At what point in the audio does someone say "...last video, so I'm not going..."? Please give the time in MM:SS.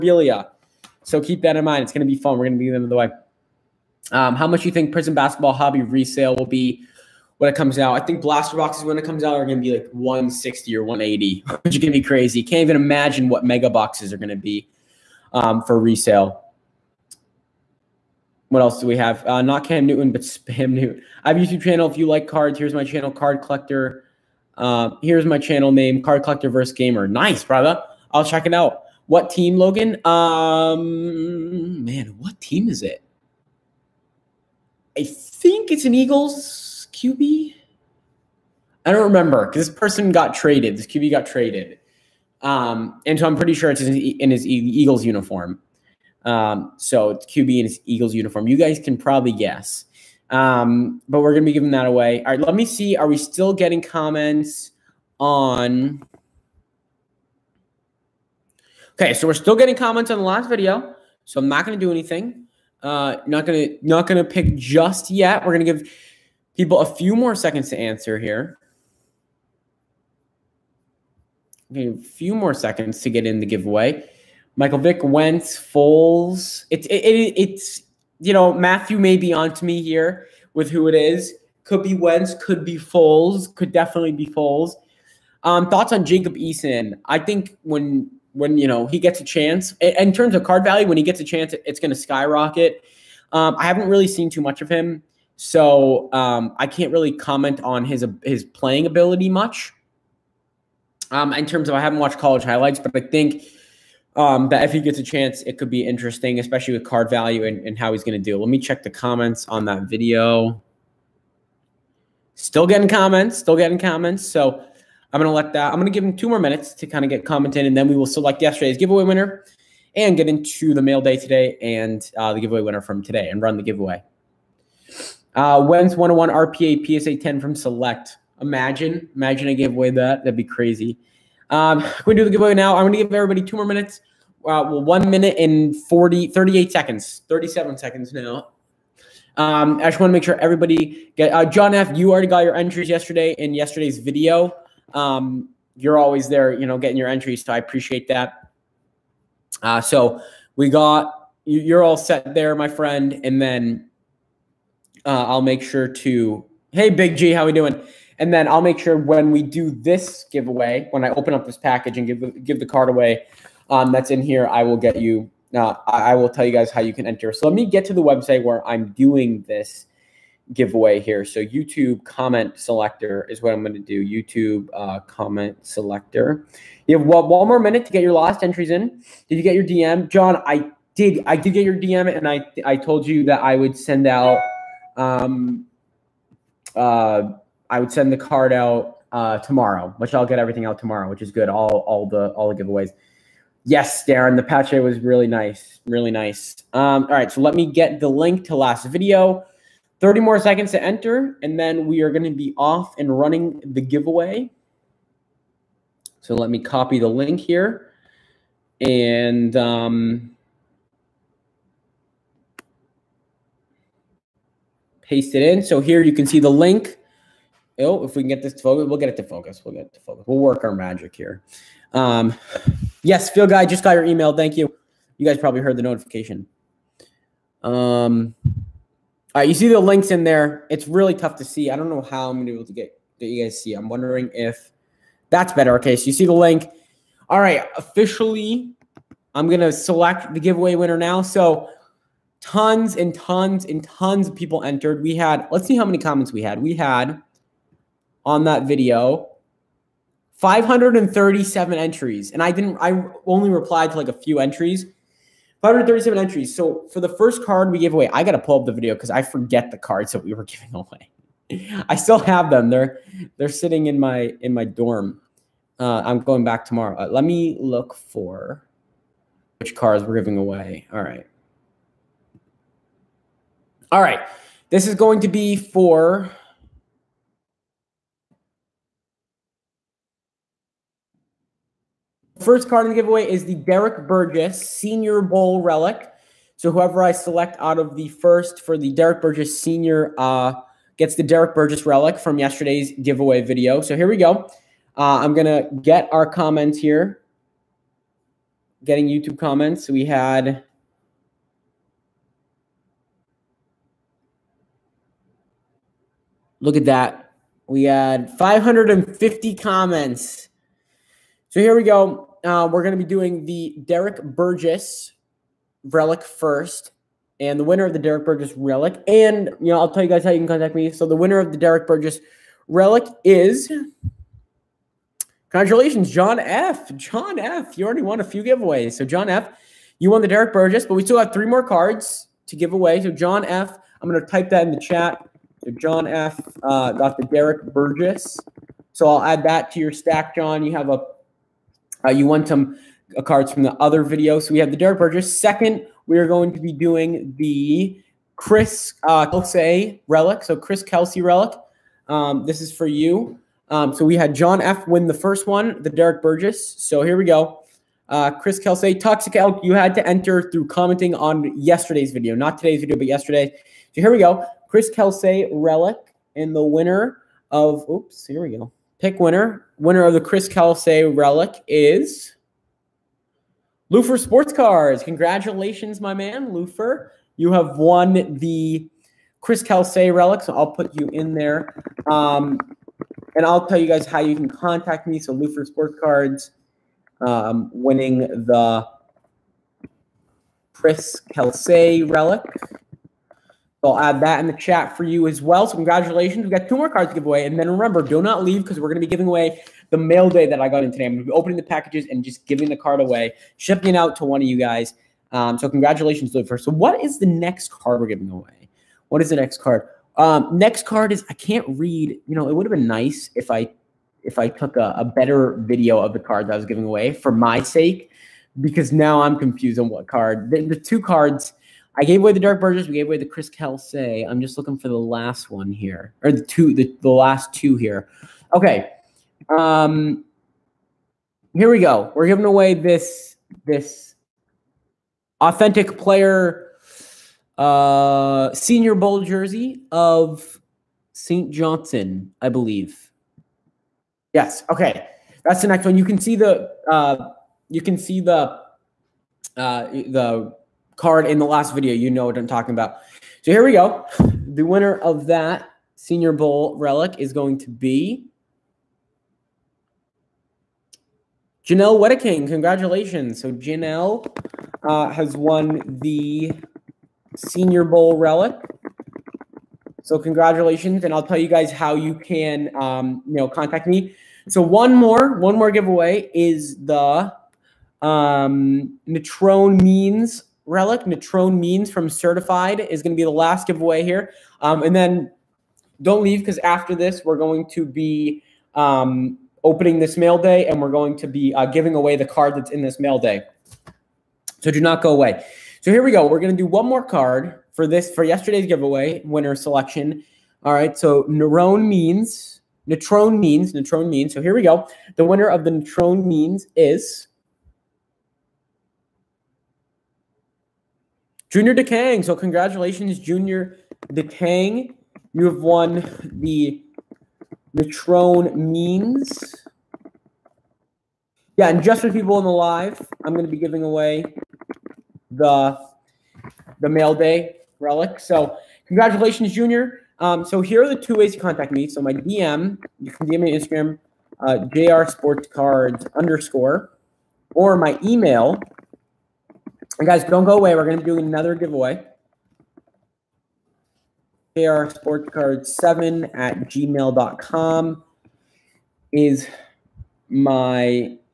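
01:00.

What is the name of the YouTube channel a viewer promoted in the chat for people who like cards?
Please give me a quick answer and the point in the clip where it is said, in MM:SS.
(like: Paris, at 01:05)
Card Collector vs. Gamer, at 00:26.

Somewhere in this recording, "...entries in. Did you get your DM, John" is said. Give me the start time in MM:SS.
02:58.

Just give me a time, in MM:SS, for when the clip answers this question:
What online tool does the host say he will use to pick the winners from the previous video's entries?
02:51.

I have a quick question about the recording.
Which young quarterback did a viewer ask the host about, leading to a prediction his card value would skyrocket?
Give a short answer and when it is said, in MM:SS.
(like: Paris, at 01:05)
Jacob Eason, at 01:26.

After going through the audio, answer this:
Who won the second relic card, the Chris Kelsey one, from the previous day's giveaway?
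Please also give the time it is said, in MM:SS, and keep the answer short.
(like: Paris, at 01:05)
Lufer Sports Cards, at 06:13.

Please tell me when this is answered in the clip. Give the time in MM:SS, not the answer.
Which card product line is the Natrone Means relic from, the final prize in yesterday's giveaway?
08:02.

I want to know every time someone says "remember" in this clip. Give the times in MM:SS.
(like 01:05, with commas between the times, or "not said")
00:39, 06:37.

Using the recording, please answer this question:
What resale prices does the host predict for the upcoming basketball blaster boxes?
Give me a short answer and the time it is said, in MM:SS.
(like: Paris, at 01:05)
160 or 180, at 00:09.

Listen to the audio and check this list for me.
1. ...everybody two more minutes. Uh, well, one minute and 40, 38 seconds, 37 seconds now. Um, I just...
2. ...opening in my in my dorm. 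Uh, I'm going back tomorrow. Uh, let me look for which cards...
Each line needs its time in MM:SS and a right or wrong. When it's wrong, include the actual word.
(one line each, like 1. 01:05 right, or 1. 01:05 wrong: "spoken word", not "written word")
1. 02:13 right
2. 04:23 wrong: "sitting", not "opening".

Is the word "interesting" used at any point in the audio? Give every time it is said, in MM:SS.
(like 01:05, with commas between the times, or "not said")
01:45.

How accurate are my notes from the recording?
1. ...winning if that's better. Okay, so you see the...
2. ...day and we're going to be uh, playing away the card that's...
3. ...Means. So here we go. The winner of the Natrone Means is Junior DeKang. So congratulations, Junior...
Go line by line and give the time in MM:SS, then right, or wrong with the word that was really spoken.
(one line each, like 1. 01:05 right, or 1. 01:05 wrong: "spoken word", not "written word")
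1. 03:53 wrong: "wondering", not "winning"
2. 08:10 wrong: "giving", not "playing"
3. 08:24 right.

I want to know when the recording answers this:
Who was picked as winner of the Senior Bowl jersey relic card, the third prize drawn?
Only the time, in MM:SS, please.
07:41.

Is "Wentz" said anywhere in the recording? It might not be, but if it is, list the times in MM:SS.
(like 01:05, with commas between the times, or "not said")
01:15, 01:21.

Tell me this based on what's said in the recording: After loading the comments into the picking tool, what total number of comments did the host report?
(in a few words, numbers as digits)
550.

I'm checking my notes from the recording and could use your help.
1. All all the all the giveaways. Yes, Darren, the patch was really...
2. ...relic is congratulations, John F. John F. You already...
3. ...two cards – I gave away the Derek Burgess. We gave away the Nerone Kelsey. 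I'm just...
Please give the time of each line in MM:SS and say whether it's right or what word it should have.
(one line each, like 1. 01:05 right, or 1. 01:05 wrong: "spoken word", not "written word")
1. 03:11 right
2. 05:22 right
3. 07:00 wrong: "Chris", not "Nerone".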